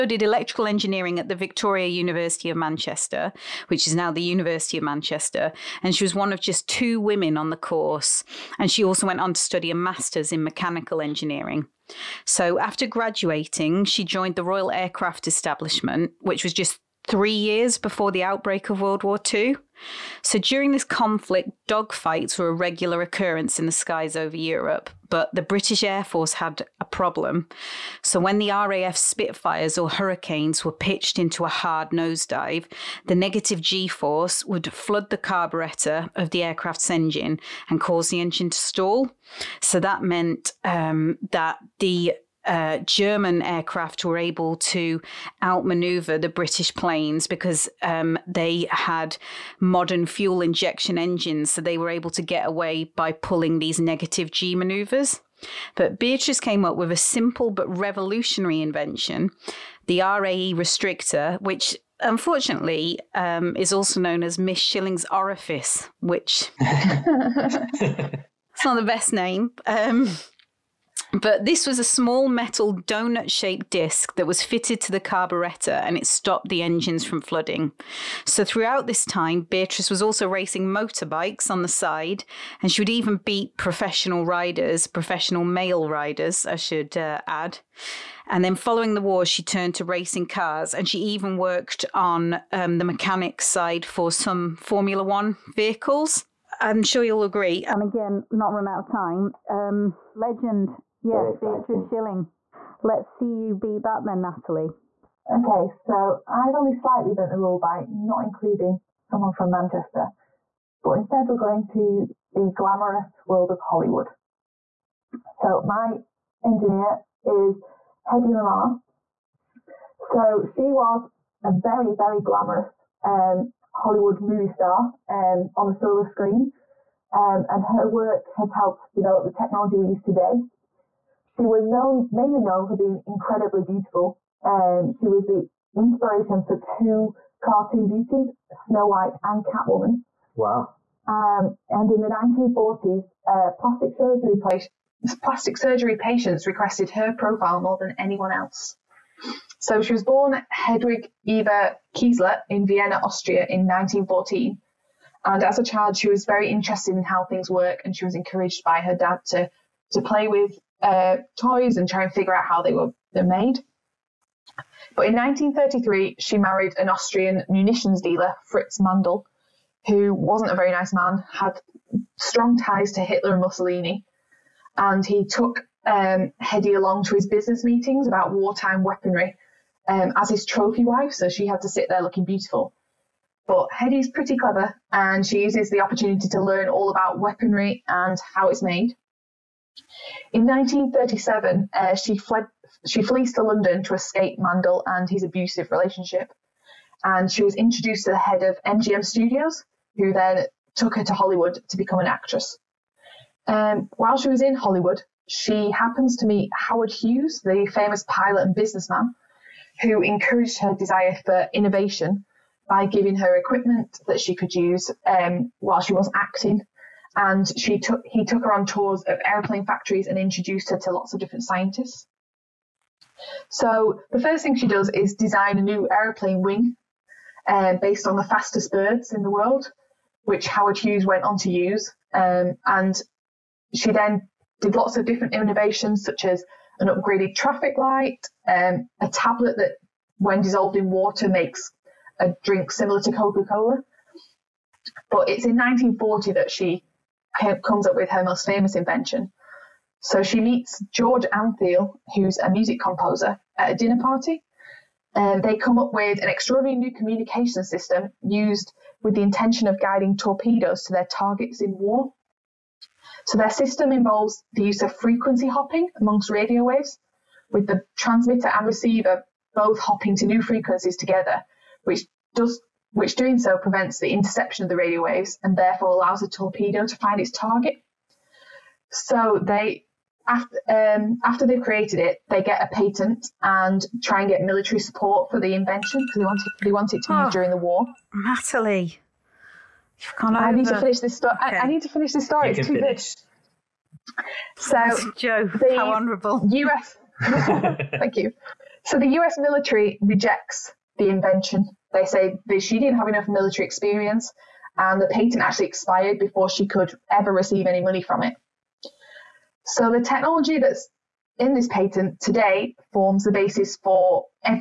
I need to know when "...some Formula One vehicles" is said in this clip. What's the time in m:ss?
1:34.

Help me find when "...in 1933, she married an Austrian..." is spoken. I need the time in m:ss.
2:45.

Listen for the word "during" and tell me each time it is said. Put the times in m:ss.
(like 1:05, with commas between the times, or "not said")
0:20, 4:47.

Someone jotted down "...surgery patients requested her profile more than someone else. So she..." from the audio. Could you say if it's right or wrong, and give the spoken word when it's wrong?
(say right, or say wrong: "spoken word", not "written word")
wrong: "anyone", not "someone".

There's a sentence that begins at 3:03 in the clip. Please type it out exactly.
But Hedy's pretty clever, and she uses the opportunity to learn all about weaponry and how it's made.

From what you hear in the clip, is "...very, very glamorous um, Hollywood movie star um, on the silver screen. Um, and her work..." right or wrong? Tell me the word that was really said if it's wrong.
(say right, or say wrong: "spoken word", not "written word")
right.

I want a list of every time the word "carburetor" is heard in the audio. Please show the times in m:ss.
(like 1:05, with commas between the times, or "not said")
0:35, 1:15.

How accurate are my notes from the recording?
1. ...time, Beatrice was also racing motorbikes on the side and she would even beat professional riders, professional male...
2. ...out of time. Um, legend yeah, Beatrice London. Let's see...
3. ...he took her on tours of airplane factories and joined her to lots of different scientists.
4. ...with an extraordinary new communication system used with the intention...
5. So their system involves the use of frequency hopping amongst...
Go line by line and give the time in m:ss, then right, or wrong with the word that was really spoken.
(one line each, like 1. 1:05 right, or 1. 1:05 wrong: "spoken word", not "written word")
1. 1:19 right
2. 1:38 wrong: "Schilling", not "London"
3. 3:38 wrong: "introduced", not "joined"
4. 4:15 right
5. 4:23 right.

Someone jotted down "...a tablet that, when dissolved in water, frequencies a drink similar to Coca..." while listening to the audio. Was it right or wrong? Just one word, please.
wrong.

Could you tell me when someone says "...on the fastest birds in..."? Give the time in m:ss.
3:48.